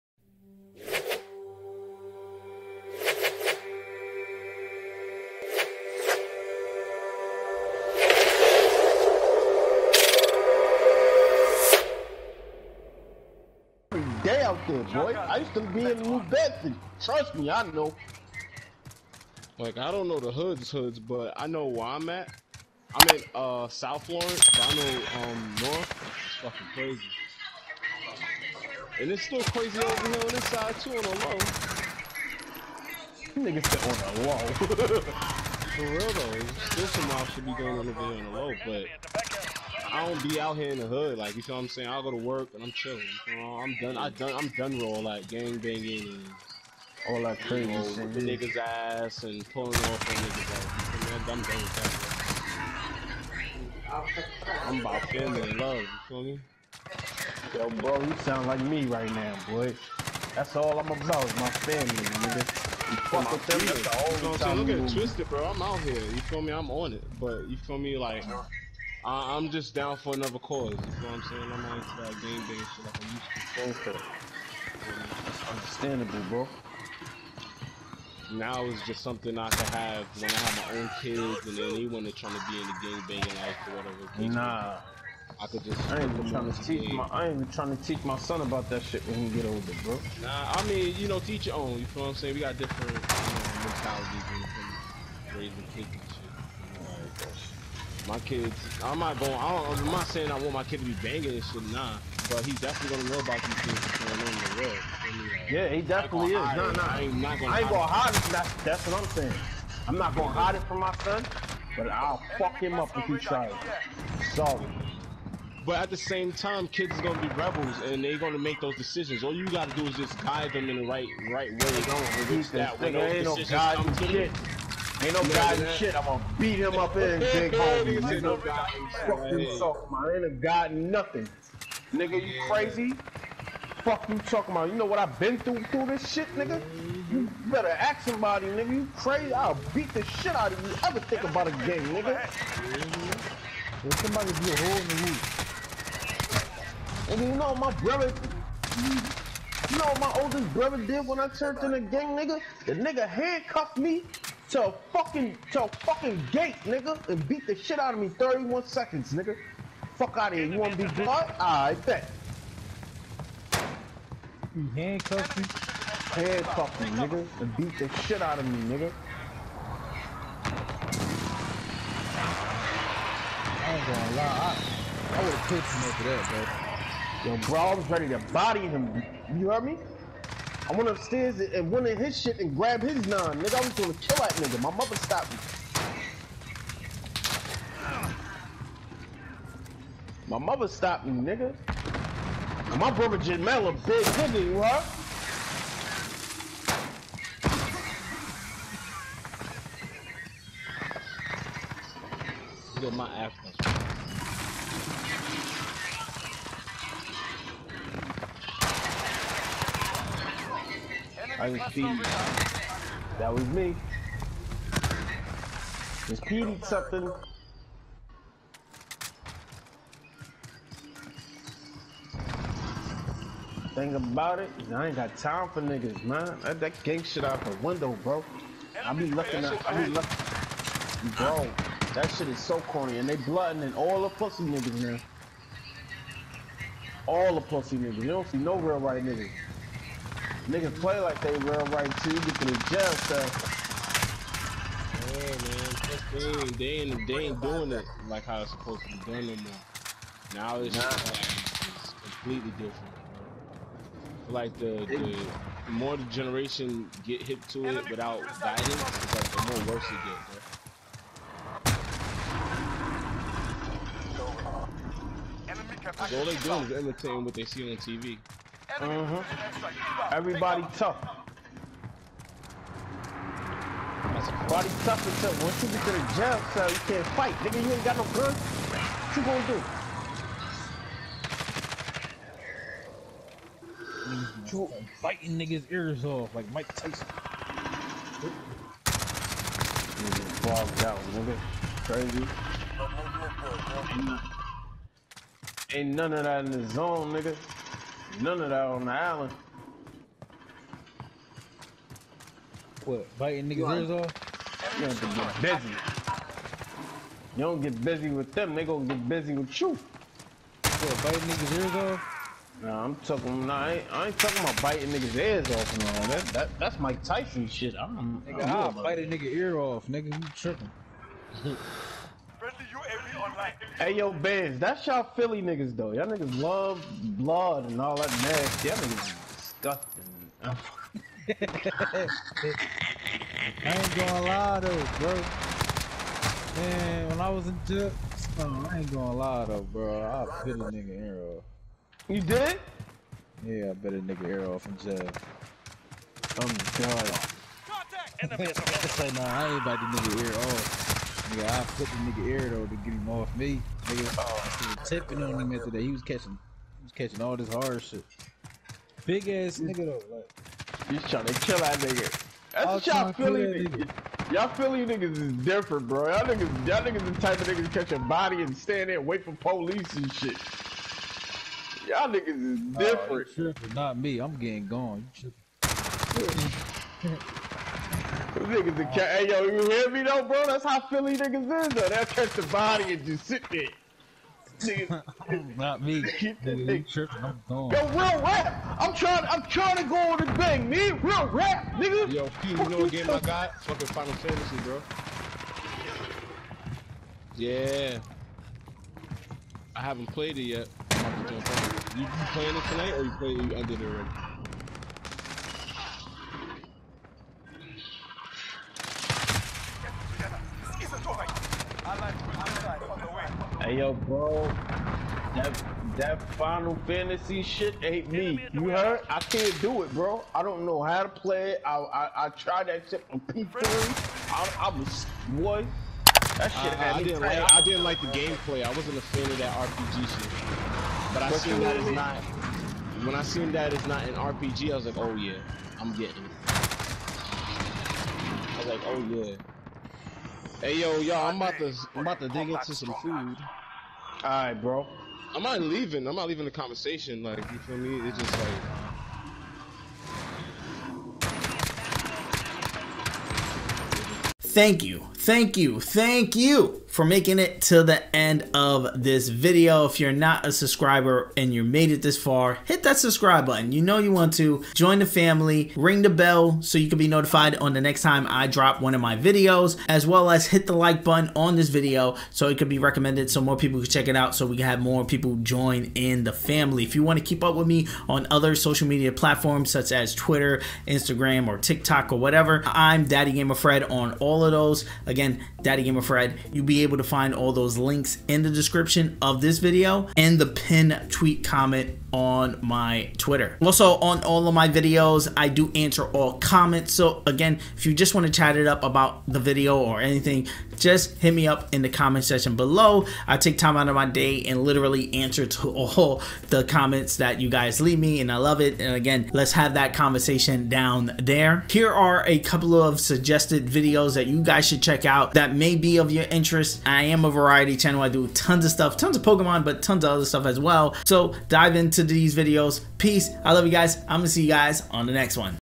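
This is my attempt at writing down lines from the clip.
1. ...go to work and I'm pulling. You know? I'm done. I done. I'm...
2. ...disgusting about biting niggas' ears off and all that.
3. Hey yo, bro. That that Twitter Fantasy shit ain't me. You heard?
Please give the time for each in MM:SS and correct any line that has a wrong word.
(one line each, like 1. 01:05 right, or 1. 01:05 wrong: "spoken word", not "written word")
1. 00:42 wrong: "chilling", not "pulling"
2. 05:14 wrong: "talking", not "disgusting"
3. 06:53 wrong: "Final", not "Twitter".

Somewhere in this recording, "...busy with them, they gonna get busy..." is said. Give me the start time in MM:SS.
05:07.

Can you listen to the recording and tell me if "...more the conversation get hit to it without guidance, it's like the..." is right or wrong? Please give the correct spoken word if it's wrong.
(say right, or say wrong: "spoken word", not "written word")
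wrong: "generation", not "conversation".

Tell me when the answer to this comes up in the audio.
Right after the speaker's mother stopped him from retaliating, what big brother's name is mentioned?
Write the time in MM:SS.
03:13.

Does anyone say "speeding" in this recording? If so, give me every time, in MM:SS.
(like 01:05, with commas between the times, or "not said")
03:31, 03:36.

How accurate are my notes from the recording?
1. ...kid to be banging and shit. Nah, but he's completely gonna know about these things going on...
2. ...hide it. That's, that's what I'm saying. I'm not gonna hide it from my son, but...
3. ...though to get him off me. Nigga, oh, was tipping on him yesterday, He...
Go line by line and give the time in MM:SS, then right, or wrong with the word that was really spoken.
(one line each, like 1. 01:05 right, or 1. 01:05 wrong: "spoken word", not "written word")
1. 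01:40 wrong: "definitely", not "completely"
2. 01:47 right
3. 05:52 right.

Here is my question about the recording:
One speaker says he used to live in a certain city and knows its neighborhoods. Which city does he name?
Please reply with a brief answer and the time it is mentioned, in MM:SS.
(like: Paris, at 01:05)
New Bedford, at 00:16.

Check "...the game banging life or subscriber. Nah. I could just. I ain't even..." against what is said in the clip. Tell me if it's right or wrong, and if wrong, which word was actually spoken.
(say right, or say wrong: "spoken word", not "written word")
wrong: "whatever", not "subscriber".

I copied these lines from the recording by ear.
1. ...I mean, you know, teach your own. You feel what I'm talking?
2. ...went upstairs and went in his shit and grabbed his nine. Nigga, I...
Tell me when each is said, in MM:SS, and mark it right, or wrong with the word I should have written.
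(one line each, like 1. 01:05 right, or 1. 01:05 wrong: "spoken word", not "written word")
1. 01:30 wrong: "saying", not "talking"
2. 03:00 right.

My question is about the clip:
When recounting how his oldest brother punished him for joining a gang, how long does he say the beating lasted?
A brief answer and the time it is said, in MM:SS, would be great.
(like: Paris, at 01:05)
31 seconds, at 02:38.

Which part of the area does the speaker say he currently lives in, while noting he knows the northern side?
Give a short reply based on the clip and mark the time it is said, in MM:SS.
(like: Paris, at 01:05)
South Florence, at 00:23.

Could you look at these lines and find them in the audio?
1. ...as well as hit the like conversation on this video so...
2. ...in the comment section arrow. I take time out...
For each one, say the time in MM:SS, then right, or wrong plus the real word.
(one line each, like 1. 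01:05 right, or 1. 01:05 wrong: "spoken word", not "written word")
1. 07:49 wrong: "button", not "conversation"
2. 08:21 wrong: "below", not "arrow".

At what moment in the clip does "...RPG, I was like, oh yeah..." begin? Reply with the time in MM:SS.
07:14.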